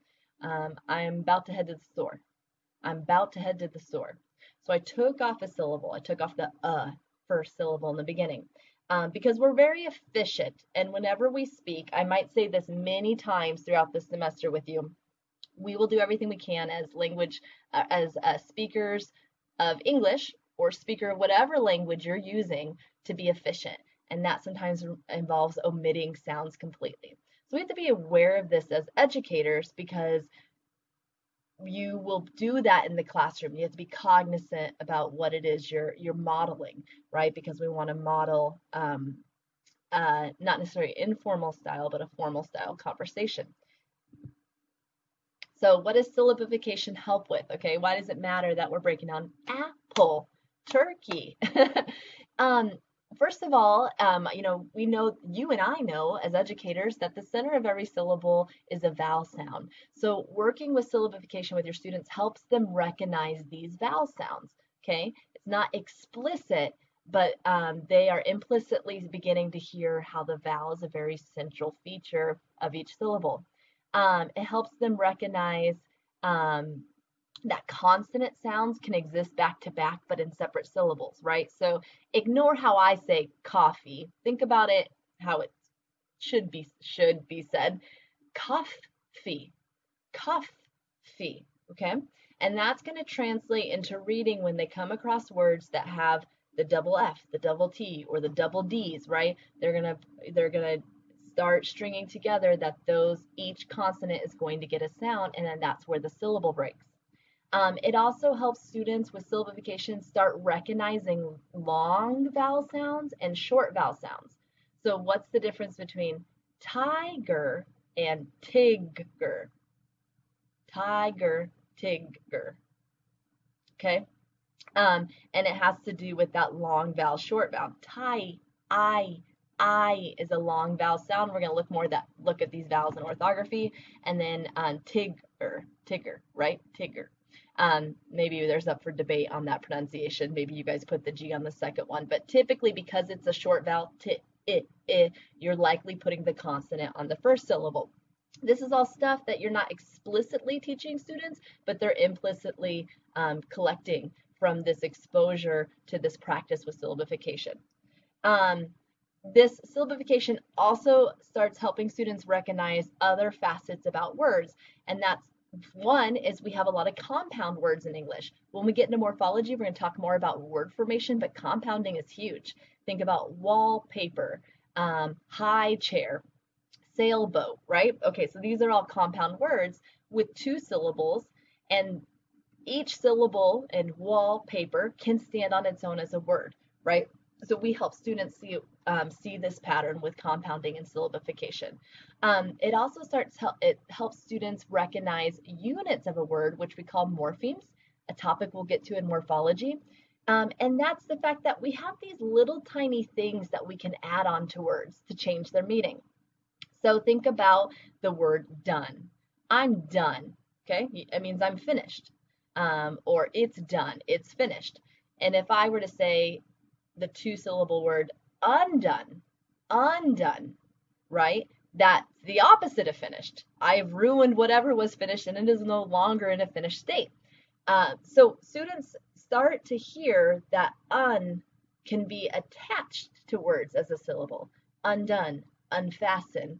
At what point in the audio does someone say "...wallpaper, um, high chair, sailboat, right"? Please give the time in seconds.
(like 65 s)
173 s.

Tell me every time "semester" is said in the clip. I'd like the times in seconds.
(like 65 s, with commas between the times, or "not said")
14 s.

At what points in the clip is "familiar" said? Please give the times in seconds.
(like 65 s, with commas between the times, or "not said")
not said.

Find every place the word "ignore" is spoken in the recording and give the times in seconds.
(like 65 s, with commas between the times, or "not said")
82 s.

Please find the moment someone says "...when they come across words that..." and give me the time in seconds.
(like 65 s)
94 s.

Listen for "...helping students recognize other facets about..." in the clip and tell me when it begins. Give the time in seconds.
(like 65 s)
161 s.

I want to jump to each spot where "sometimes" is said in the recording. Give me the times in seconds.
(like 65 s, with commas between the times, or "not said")
24 s.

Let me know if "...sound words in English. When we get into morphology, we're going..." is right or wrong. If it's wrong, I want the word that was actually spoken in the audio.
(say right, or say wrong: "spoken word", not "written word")
wrong: "compound", not "sound".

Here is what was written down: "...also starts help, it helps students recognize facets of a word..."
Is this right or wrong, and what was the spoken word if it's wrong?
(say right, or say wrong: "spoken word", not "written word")
wrong: "units", not "facets".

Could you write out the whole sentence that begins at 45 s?
So what does syllabification help with?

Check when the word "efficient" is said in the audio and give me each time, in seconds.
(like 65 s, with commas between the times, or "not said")
9 s, 23 s.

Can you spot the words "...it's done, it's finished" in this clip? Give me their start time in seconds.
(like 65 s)
213 s.